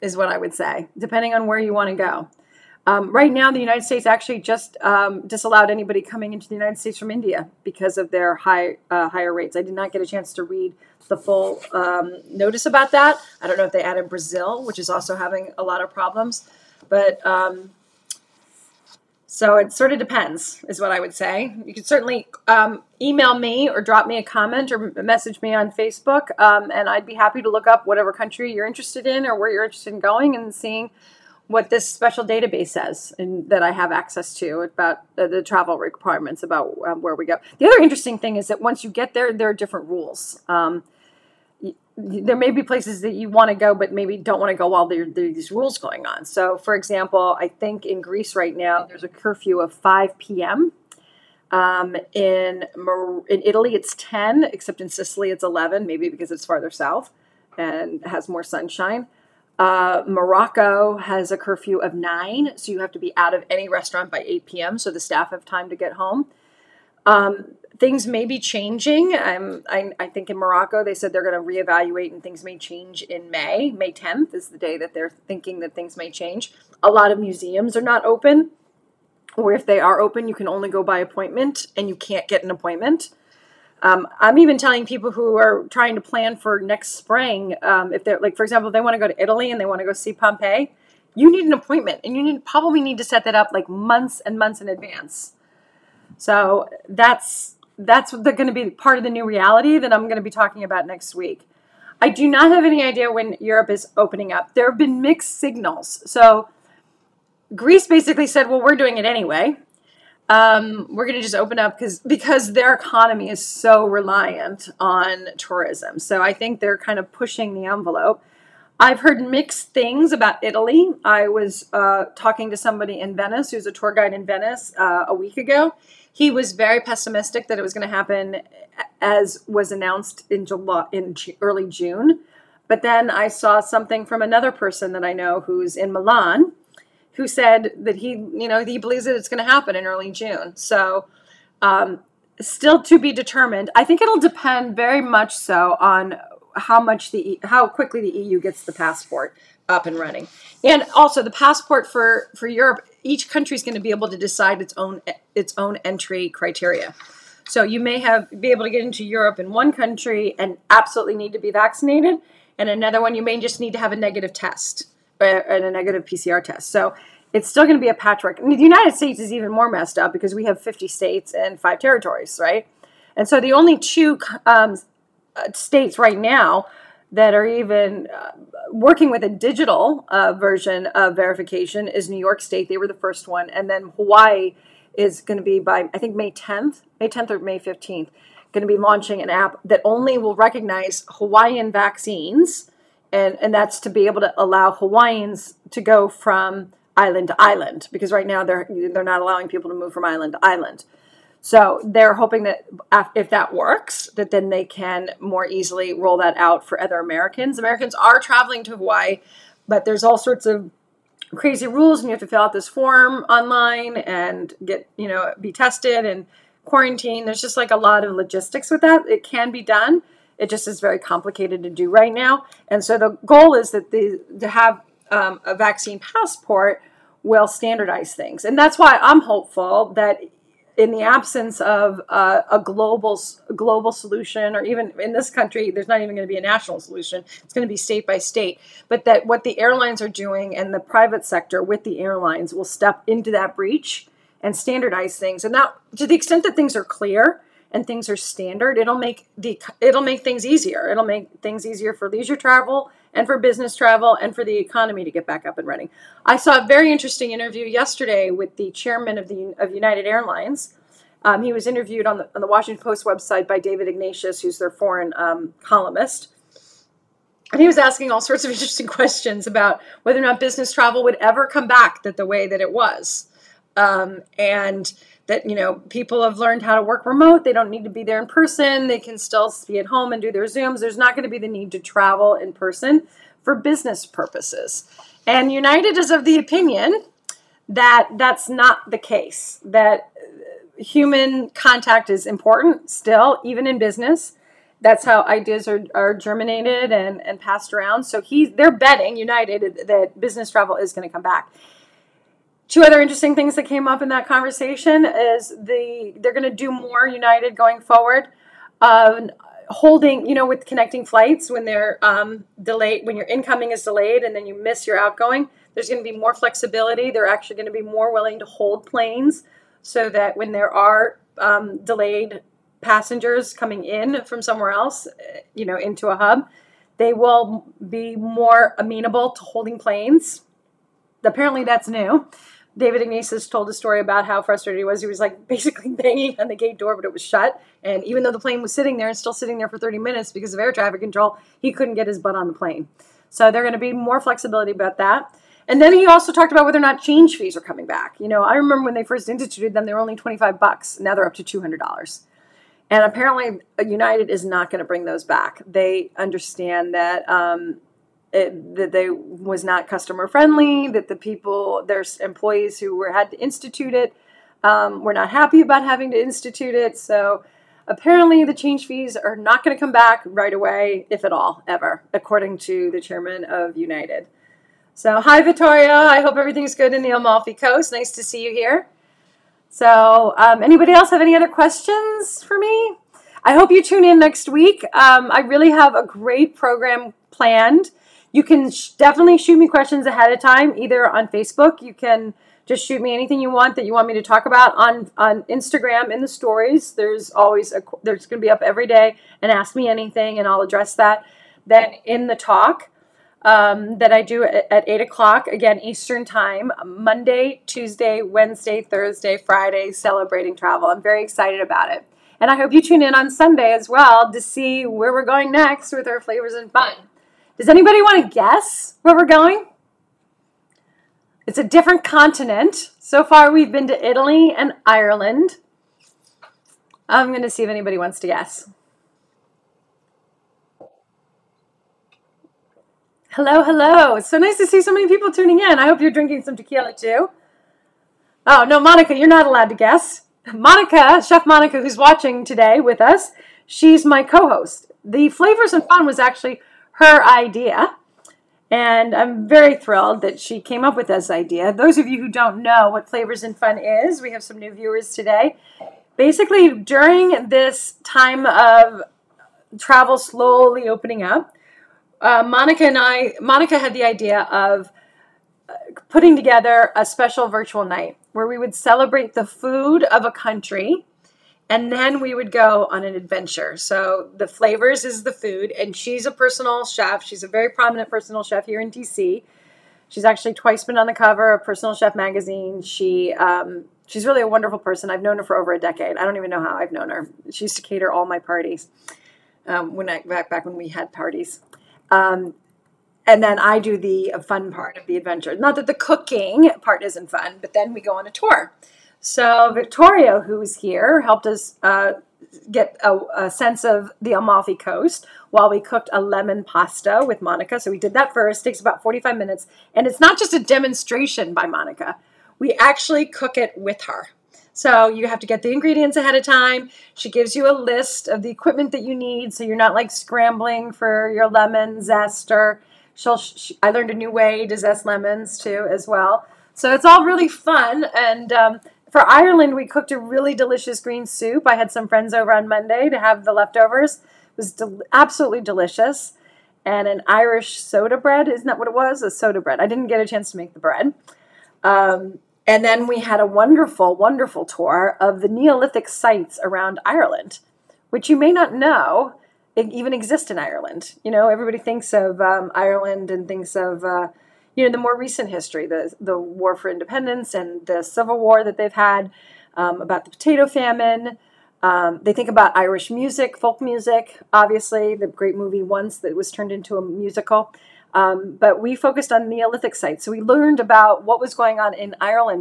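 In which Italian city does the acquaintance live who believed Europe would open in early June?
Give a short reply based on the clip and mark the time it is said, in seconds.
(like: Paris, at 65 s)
Milan, at 135 s.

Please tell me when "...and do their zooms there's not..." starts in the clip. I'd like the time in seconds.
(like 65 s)
280 s.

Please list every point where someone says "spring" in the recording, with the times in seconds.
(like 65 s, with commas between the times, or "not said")
86 s.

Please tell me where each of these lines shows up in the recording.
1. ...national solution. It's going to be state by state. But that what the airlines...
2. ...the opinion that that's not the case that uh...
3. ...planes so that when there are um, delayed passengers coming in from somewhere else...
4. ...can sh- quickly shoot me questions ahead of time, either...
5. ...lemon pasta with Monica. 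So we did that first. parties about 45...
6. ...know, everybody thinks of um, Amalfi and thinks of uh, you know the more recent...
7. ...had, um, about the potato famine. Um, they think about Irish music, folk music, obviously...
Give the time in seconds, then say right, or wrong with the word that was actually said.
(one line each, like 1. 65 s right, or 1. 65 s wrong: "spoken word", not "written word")
1. 236 s right
2. 286 s right
3. 318 s right
4. 388 s wrong: "definitely", not "quickly"
5. 506 s wrong: "takes", not "parties"
6. 551 s wrong: "Ireland", not "Amalfi"
7. 558 s right.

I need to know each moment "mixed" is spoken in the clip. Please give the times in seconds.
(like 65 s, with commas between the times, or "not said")
105 s, 119 s.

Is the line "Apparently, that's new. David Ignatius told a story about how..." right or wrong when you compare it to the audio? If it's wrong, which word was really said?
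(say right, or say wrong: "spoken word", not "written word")
right.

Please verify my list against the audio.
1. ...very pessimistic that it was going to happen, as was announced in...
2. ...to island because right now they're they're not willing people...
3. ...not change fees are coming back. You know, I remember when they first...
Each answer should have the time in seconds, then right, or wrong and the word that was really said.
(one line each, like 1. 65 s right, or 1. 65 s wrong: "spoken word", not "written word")
1. 126 s right
2. 197 s wrong: "allowing", not "willing"
3. 346 s right.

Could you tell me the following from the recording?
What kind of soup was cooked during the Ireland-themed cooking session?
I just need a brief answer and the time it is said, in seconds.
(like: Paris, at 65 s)
green soup, at 530 s.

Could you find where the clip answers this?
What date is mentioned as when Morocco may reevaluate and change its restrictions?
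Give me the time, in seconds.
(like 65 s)
73 s.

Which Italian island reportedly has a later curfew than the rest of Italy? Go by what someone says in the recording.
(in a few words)
Sicily.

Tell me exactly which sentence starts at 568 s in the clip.
Um, but we focused on Neolithic sites.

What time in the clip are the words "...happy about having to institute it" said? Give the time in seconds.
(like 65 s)
365 s.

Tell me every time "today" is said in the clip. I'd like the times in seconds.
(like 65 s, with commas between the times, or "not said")
442 s, 455 s.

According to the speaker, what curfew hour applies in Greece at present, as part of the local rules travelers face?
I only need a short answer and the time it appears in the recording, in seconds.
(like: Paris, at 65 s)
5 p.m., at 49 s.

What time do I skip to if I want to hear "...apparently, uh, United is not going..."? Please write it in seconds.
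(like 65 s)
353 s.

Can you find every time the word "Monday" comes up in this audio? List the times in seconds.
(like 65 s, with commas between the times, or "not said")
406 s, 532 s.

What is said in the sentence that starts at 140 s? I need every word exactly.
So, um, still to be determined.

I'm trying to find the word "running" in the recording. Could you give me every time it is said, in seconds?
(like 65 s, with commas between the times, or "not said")
149 s, 255 s.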